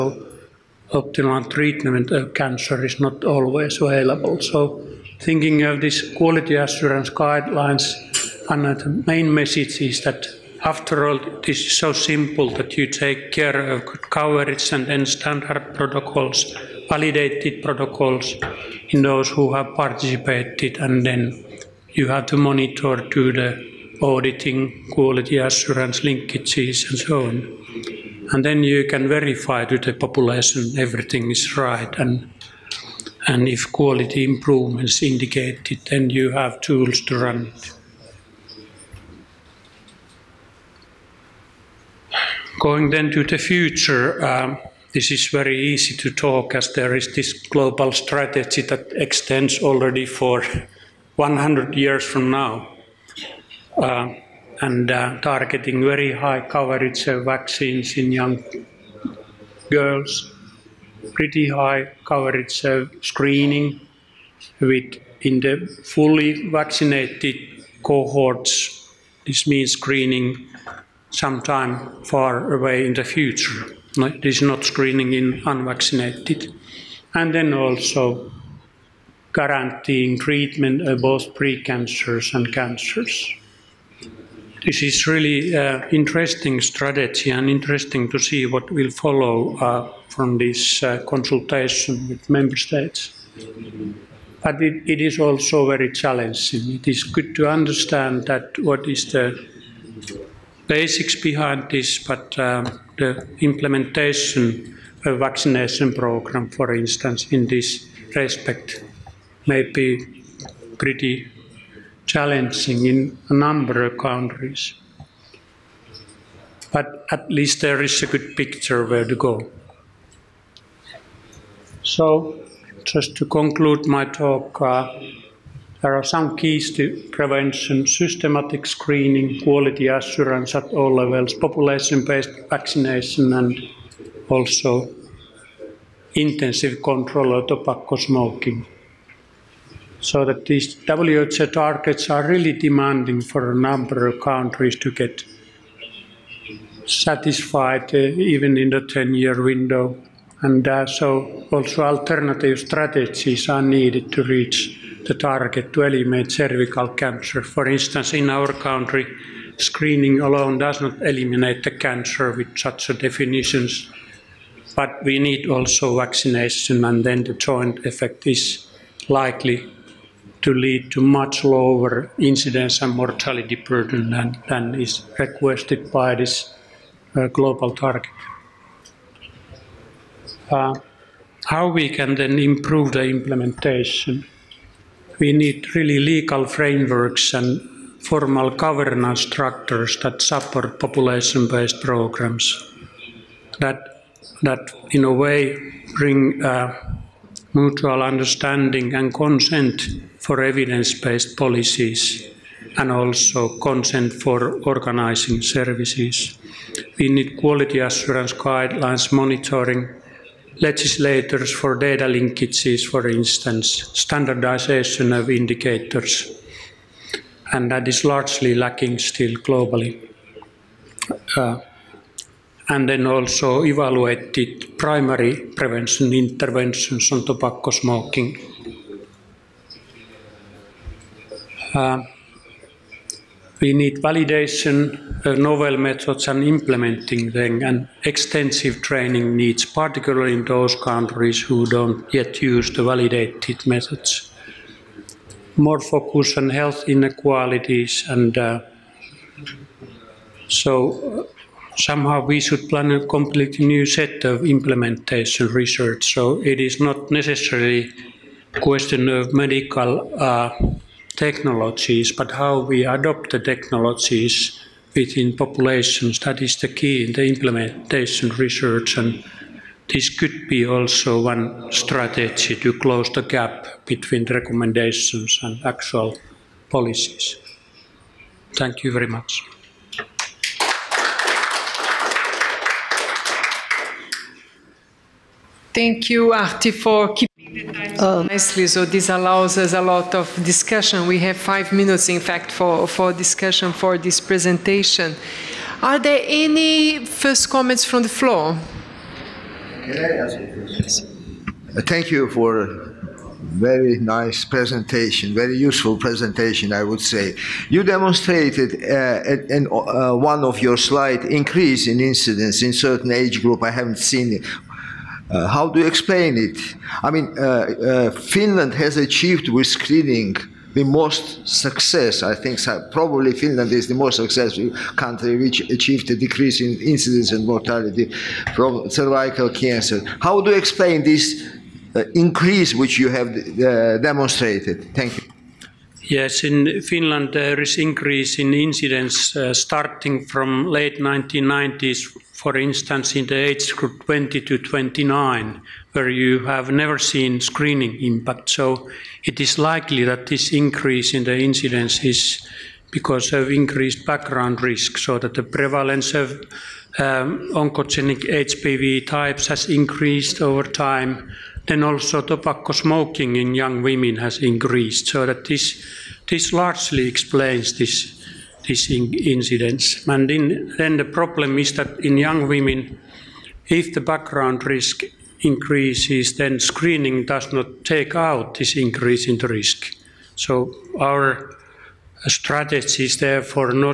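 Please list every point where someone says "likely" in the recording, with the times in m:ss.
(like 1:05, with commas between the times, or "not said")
2:49, 5:49.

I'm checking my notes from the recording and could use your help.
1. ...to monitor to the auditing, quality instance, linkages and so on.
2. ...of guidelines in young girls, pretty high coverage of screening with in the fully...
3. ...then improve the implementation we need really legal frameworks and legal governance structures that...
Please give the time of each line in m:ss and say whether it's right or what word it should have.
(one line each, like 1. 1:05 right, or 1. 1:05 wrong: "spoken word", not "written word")
1. 0:22 wrong: "assurance", not "instance"
2. 0:57 wrong: "vaccines", not "guidelines"
3. 3:02 wrong: "formal", not "legal".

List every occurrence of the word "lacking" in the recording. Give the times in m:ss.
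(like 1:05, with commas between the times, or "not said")
3:38.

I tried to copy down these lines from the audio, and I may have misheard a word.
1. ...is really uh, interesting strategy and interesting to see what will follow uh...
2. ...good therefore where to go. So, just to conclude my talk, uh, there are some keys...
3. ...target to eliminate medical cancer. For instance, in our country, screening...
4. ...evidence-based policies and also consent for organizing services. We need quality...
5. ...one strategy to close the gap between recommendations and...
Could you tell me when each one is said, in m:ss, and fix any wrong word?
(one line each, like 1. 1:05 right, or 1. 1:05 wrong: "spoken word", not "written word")
1. 1:24 right
2. 1:58 wrong: "picture", not "therefore"
3. 2:35 wrong: "cervical", not "medical"
4. 3:20 right
5. 4:31 right.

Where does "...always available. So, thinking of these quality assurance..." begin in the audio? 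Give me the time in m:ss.
0:03.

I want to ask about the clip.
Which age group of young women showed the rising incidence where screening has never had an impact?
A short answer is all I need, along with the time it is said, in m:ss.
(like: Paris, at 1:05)
20 to 29, at 5:44.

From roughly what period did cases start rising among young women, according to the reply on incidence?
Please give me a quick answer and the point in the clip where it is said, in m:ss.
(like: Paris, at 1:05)
late 1990s, at 5:40.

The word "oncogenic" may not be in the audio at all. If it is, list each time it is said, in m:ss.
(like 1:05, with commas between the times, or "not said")
5:57.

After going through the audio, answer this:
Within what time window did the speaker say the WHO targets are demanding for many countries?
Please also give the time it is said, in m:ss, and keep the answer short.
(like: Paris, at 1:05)
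10-year window, at 2:28.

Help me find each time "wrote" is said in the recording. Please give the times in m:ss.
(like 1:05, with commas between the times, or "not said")
not said.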